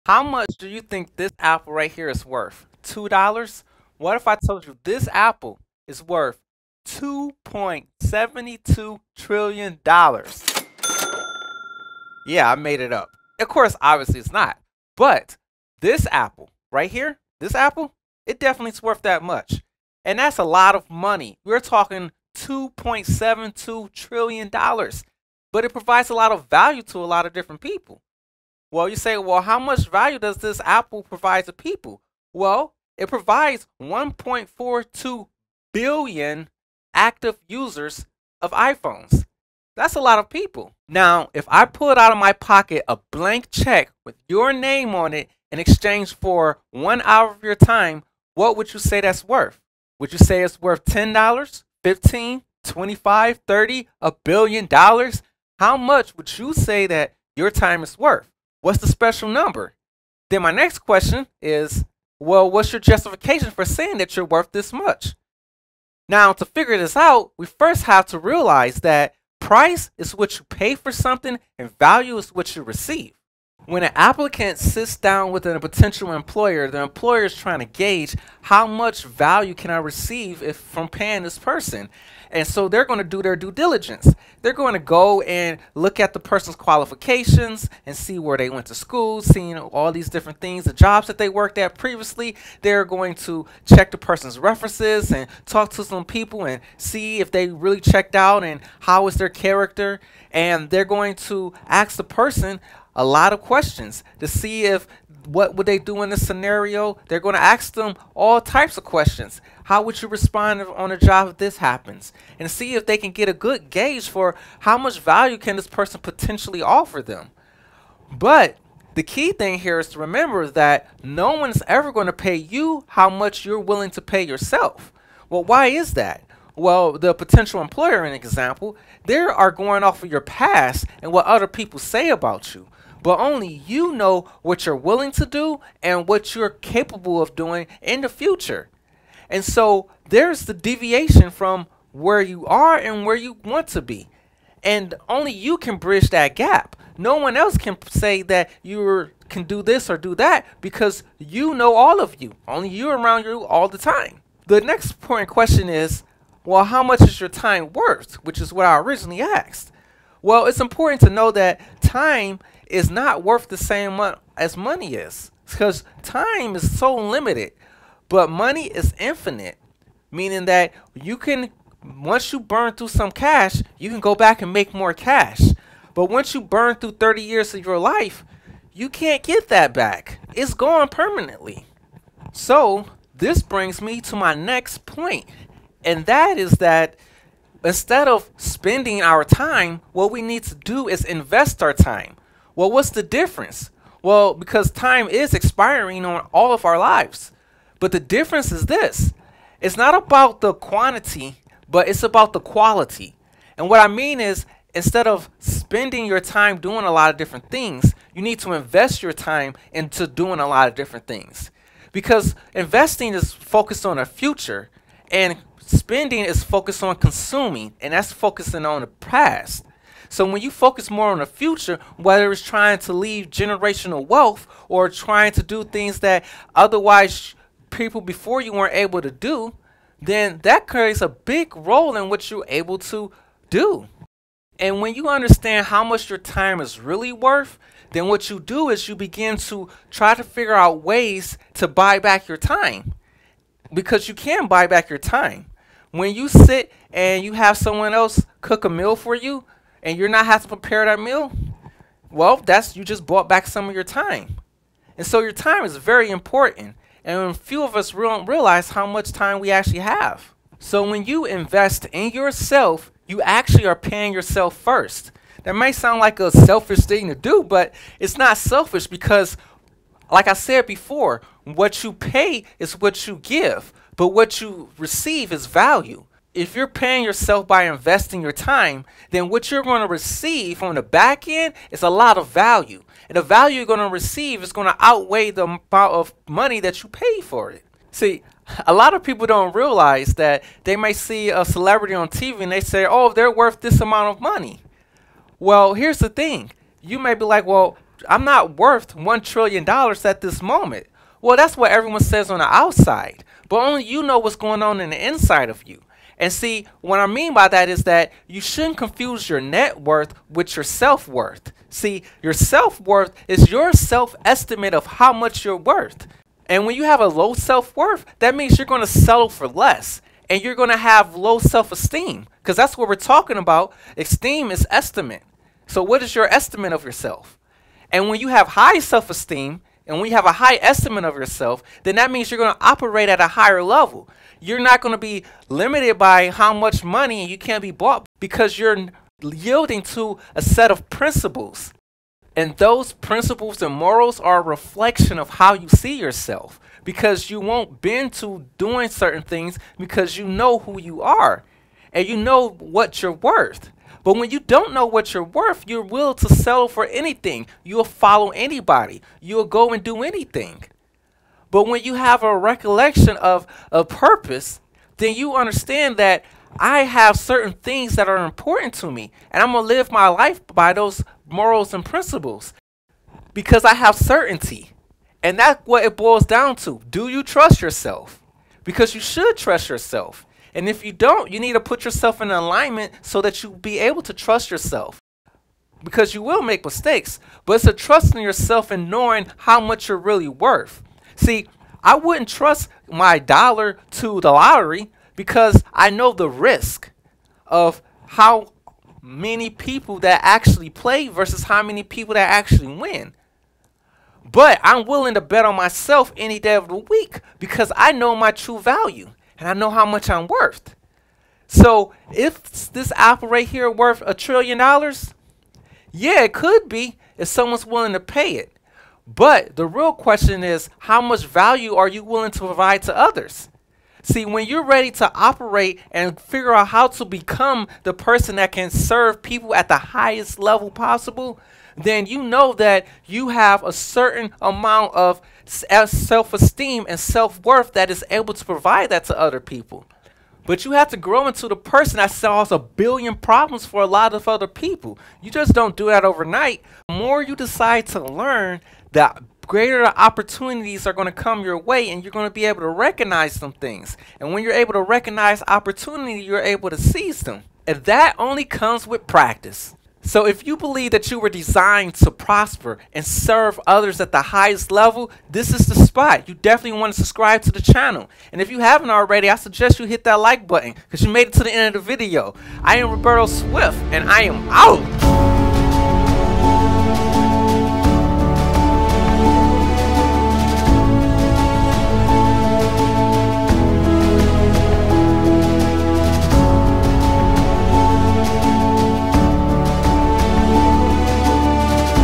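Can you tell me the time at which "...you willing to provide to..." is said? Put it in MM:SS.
07:01.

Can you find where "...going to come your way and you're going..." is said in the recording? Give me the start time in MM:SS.
07:30.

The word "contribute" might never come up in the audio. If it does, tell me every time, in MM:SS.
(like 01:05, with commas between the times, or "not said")
not said.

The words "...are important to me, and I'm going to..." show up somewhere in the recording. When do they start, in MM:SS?
06:08.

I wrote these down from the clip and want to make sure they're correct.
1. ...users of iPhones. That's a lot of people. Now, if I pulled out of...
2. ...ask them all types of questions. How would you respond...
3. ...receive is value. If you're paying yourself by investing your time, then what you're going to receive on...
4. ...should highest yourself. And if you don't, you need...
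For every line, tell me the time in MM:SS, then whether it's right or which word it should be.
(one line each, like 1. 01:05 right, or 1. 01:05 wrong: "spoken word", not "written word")
1. 00:37 right
2. 01:47 right
3. 04:34 right
4. 06:19 wrong: "trust", not "highest".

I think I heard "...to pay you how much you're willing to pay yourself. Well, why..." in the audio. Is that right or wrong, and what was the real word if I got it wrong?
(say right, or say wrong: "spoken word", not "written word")
right.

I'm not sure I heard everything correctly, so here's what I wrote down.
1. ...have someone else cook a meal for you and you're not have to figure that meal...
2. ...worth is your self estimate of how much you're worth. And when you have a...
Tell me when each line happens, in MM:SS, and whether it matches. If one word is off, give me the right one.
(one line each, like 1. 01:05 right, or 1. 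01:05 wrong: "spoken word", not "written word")
1. 04:07 wrong: "prepare", not "figure"
2. 05:12 right.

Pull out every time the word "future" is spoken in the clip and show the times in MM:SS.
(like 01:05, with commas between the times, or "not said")
02:18, 03:34, 03:41.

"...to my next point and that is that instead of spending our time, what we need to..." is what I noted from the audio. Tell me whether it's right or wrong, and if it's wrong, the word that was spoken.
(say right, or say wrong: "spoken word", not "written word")
right.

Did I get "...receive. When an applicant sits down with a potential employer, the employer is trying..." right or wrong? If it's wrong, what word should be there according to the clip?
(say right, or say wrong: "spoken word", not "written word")
right.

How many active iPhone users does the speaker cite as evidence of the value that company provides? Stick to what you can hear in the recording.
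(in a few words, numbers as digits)
1.42 billion.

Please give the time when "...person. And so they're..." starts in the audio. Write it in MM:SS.
01:21.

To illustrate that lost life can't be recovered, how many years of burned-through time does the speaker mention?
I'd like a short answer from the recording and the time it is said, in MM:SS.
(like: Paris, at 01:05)
30 years, at 02:56.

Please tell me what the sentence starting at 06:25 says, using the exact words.
Because you will make mistakes, but it's a trust in yourself and knowing how much you're really worth.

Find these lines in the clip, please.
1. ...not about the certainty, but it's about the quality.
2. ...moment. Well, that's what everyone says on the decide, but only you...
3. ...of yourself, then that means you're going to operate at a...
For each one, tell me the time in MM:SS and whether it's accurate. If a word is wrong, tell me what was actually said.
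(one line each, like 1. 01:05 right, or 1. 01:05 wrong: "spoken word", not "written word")
1. 03:19 wrong: "quantity", not "certainty"
2. 05:00 wrong: "outside", not "decide"
3. 05:31 right.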